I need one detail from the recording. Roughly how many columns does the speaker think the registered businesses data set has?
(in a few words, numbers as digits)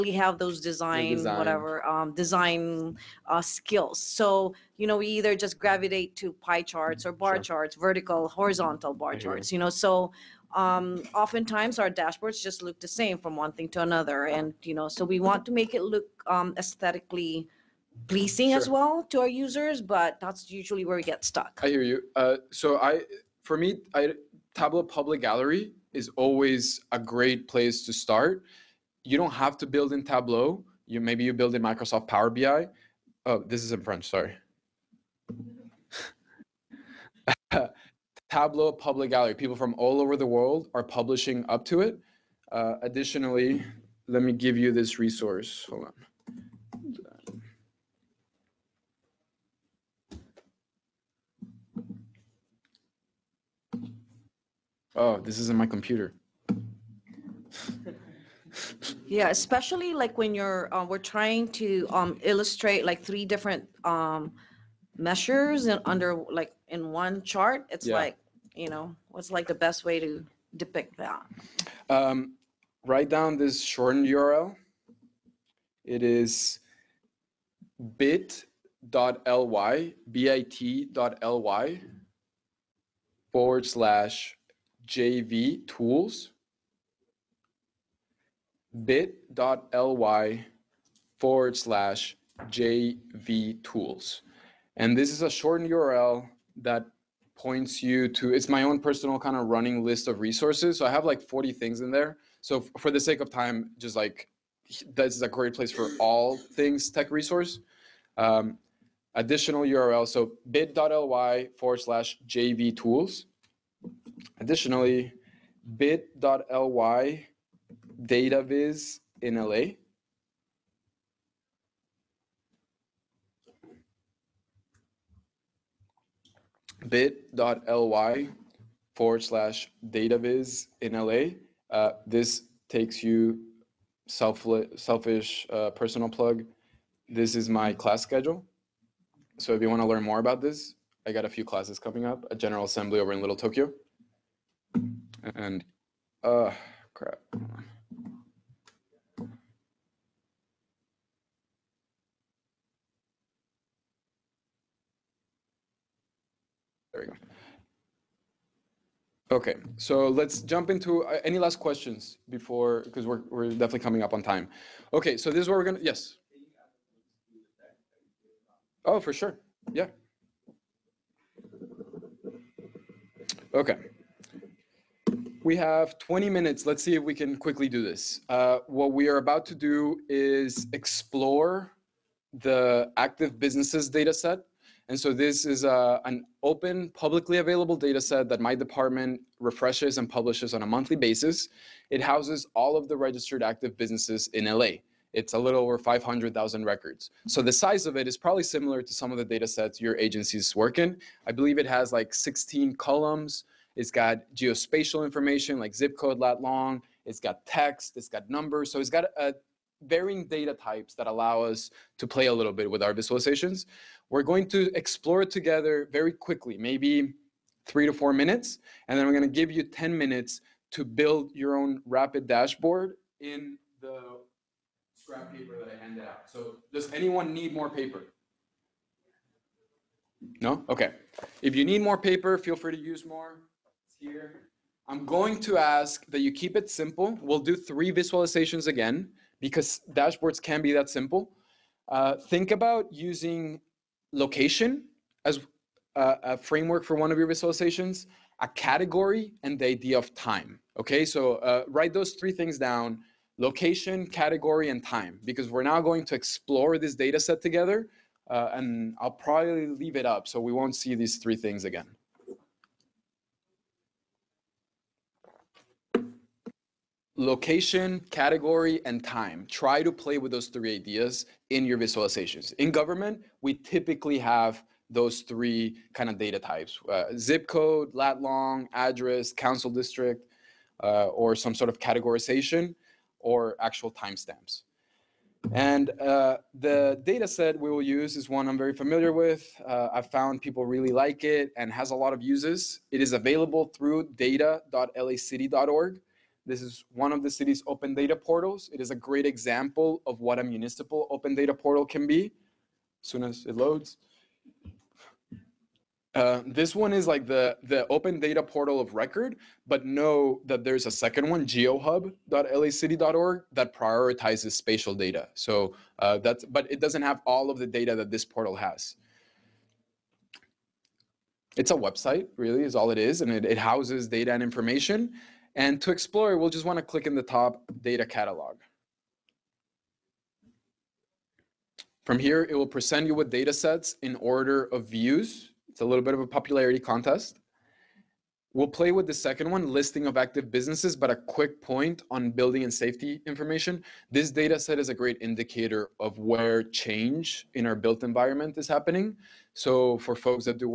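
16.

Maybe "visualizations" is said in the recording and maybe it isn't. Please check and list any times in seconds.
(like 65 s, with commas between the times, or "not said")
212 s, 237 s, 247 s, 271 s.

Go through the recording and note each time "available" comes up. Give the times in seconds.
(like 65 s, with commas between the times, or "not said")
187 s, 293 s.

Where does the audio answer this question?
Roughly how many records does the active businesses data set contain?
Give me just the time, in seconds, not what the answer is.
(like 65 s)
195 s.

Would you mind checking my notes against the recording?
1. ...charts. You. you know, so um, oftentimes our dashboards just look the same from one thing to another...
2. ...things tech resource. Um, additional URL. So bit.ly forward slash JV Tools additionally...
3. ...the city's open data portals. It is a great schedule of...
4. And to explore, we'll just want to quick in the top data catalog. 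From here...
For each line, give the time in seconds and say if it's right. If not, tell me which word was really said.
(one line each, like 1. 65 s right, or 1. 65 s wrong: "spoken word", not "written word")
1. 9 s right
2. 106 s right
3. 297 s wrong: "example", not "schedule"
4. 325 s wrong: "click", not "quick".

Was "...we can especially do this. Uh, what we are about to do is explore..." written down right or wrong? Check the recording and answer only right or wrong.
wrong.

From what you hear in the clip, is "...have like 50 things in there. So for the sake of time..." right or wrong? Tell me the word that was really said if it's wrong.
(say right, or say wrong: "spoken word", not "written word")
wrong: "40", not "50".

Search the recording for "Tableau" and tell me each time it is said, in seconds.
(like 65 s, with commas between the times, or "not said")
24 s, 30 s, 38 s.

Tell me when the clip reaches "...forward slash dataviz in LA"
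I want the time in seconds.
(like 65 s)
128 s.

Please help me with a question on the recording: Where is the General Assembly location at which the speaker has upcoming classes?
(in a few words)
Little Tokyo.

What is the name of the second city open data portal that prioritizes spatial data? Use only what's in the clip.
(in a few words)
geohub.lacity.org.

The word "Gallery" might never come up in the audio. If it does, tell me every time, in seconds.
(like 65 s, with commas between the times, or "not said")
25 s, 39 s.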